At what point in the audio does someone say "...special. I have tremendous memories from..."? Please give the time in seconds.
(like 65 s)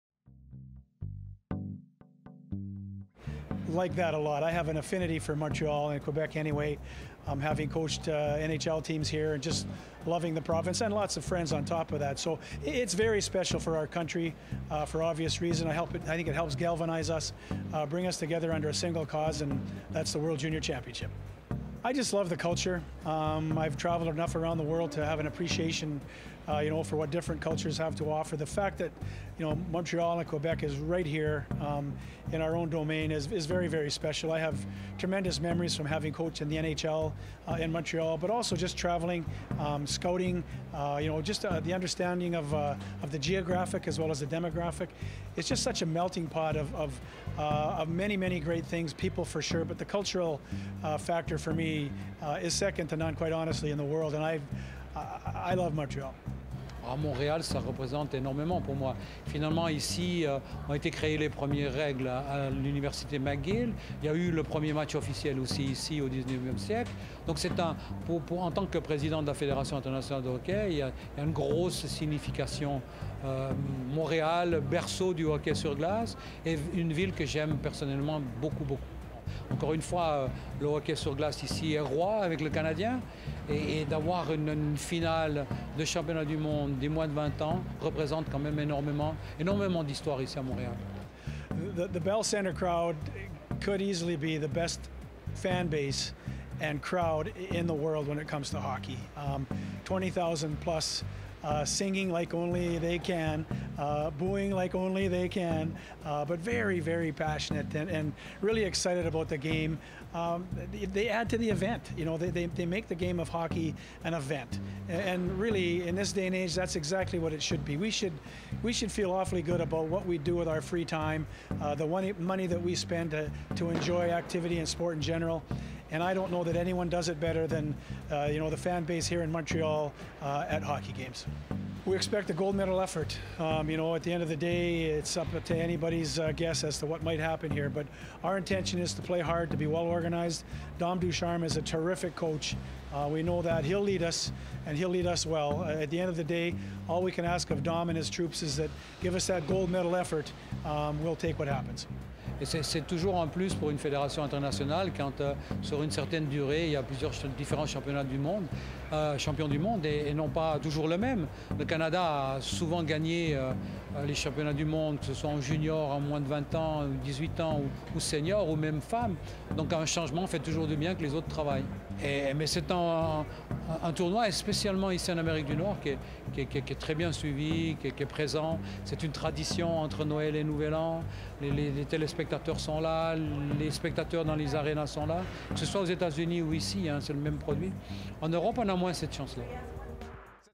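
33 s.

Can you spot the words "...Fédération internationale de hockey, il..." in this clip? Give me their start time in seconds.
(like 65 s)
69 s.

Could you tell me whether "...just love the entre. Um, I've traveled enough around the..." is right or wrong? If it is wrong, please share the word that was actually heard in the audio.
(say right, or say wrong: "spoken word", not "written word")
wrong: "culture", not "entre".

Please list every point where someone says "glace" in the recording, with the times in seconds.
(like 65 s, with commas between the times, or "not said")
75 s, 81 s.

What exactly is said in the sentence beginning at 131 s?
We expect a gold medal effort.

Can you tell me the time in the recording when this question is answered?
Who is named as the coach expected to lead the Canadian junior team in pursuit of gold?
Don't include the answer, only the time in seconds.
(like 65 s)
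140 s.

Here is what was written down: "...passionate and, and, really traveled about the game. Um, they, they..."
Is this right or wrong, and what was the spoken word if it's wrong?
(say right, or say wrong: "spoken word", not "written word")
wrong: "excited", not "traveled".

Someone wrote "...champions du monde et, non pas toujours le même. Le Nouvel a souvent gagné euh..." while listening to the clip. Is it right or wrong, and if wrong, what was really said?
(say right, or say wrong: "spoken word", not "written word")
wrong: "Canada", not "Nouvel".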